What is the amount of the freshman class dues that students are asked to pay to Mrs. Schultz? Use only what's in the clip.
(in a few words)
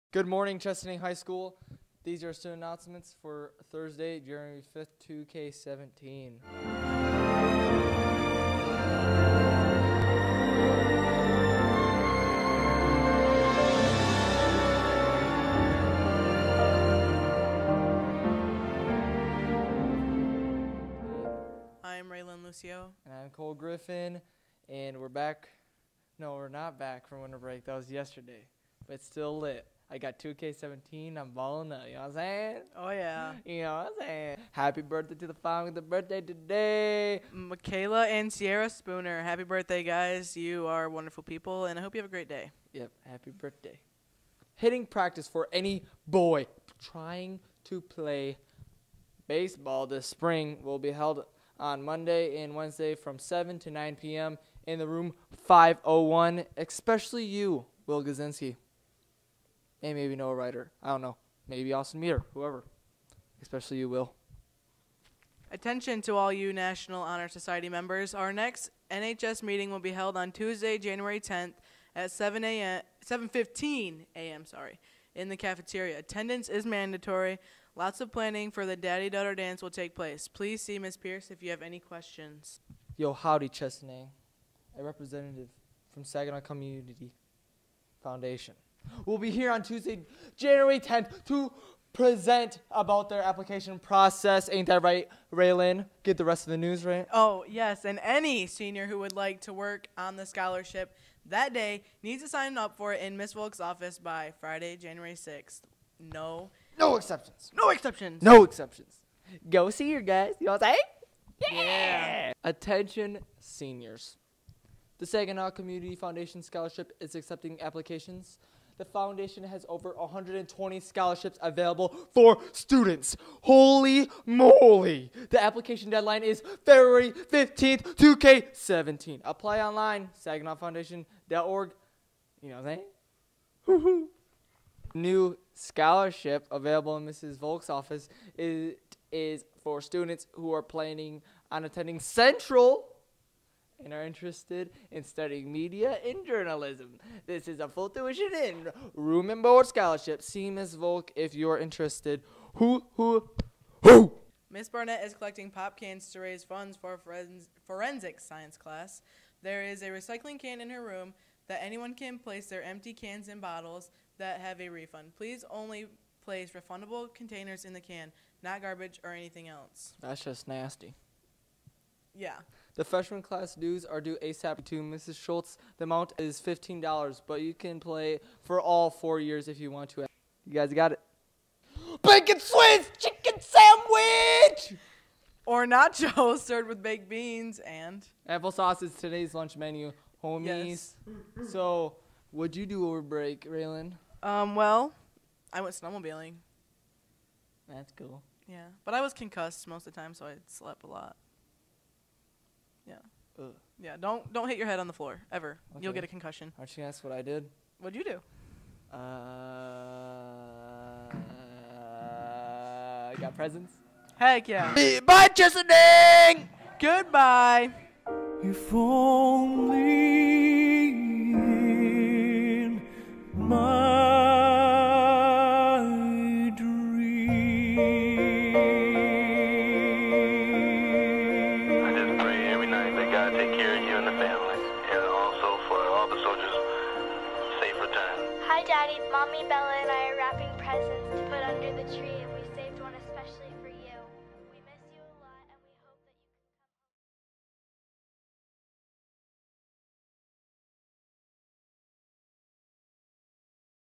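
$15.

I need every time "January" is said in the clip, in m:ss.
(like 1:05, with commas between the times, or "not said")
0:04, 1:10, 1:30, 1:44.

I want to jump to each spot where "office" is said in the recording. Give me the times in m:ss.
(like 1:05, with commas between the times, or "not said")
1:43, 2:17.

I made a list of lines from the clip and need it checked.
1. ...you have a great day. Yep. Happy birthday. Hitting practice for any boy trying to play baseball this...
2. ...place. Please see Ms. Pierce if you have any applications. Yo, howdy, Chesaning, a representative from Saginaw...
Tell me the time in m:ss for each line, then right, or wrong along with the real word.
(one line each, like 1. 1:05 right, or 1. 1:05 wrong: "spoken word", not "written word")
1. 0:41 right
2. 1:19 wrong: "questions", not "applications".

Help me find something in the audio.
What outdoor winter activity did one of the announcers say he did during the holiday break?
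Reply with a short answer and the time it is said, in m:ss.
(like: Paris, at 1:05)
snowmobiling, at 3:15.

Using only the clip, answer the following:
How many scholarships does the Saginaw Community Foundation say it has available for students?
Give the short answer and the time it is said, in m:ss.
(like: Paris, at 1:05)
over 120, at 1:59.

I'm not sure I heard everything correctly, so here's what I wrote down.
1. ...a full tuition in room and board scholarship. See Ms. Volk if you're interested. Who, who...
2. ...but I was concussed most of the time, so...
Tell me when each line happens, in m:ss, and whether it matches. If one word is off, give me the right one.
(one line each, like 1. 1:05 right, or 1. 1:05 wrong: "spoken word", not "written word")
1. 2:27 right
2. 3:18 right.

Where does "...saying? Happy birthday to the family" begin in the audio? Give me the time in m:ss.
0:34.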